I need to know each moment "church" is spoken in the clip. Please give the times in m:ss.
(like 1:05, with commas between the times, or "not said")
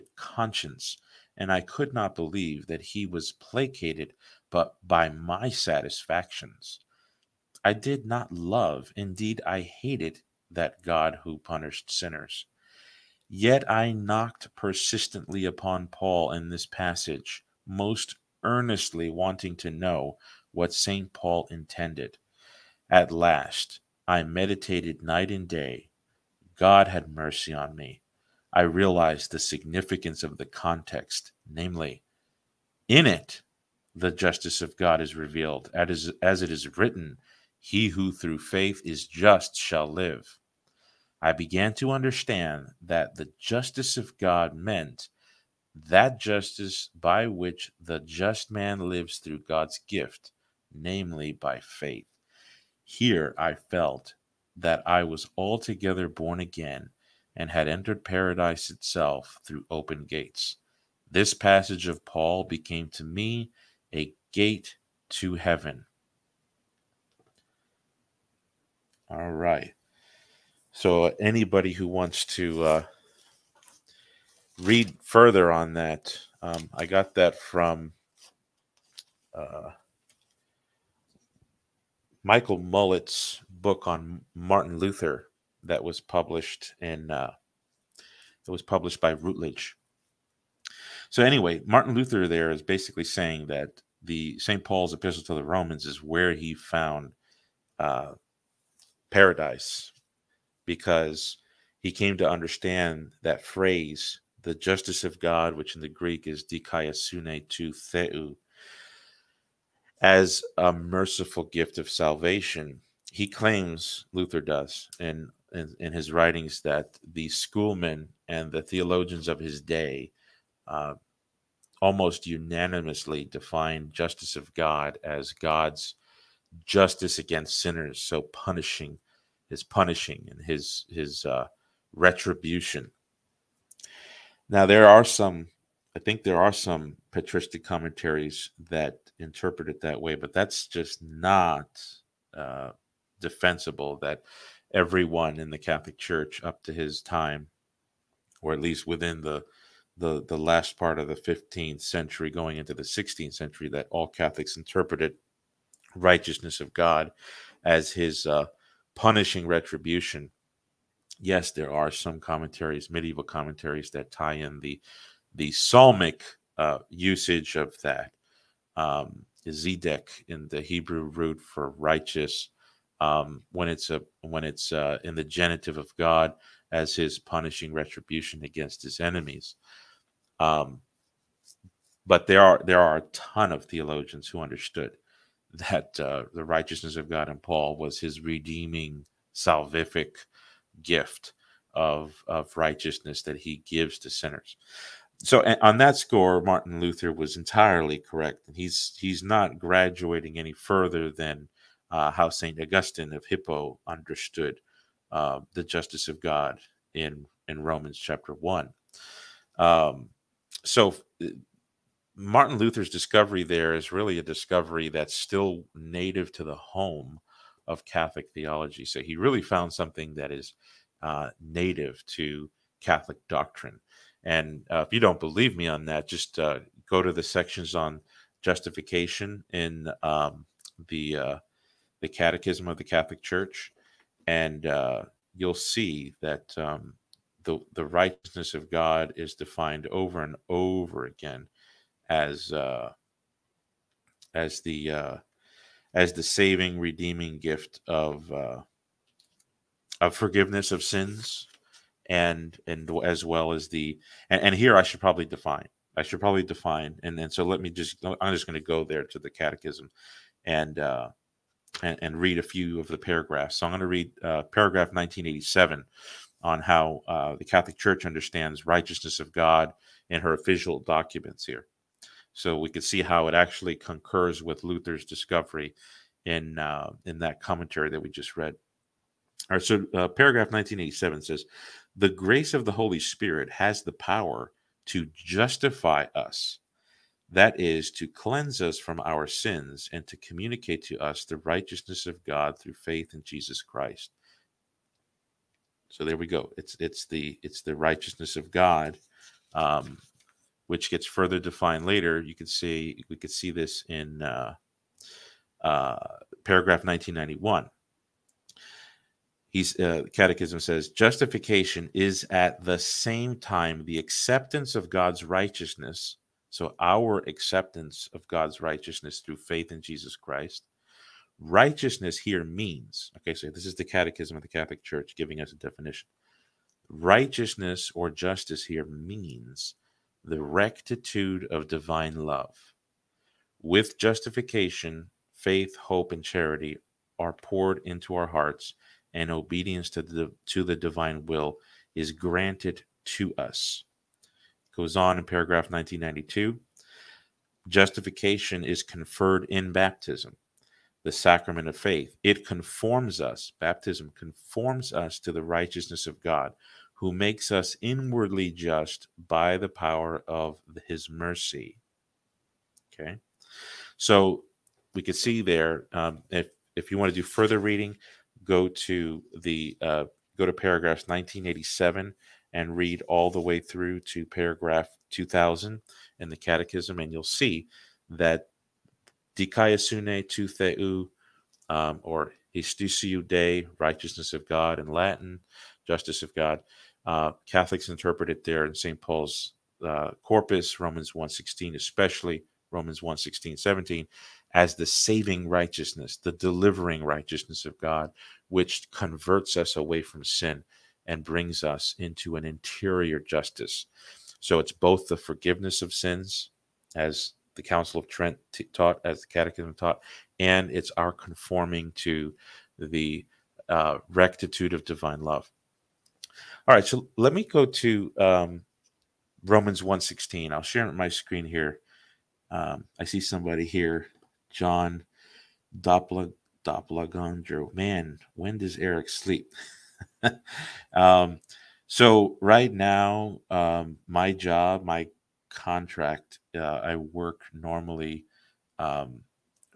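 2:25, 3:53, 4:27, 5:24.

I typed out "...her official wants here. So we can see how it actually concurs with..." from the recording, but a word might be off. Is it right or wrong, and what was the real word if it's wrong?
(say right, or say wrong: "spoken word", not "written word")
wrong: "documents", not "wants".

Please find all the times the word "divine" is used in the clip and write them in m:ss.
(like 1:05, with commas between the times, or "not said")
5:31, 5:40, 6:54.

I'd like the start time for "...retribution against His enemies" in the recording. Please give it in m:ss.
2:57.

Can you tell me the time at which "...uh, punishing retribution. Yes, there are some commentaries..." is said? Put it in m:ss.
2:38.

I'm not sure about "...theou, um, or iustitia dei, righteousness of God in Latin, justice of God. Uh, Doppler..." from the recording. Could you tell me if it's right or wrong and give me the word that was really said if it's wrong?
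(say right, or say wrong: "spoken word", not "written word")
wrong: "Catholics", not "Doppler".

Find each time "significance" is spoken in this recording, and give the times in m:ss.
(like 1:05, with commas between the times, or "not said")
0:29.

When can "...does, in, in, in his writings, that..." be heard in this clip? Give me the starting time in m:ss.
1:54.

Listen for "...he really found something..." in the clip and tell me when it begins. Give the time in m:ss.
3:39.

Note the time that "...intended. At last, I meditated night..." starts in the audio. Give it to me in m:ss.
0:21.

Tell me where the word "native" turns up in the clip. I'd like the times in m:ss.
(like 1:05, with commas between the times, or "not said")
3:35, 3:41.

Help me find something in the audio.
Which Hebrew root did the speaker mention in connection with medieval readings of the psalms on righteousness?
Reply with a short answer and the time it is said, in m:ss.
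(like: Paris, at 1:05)
zedek, at 2:49.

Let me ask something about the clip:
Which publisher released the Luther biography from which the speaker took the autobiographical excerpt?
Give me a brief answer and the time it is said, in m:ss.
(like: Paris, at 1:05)
Routledge, at 1:29.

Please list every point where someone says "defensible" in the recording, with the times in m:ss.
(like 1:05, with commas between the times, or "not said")
2:23.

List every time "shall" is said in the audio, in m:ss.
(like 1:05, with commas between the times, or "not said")
0:39.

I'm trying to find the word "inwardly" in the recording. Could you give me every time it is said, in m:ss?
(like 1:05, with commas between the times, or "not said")
5:57.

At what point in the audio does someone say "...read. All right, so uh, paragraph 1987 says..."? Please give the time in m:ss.
4:38.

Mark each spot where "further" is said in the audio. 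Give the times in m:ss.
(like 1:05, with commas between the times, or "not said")
1:15, 3:20, 5:01, 6:07.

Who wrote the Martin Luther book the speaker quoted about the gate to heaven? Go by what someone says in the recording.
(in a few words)
Michael Mullett.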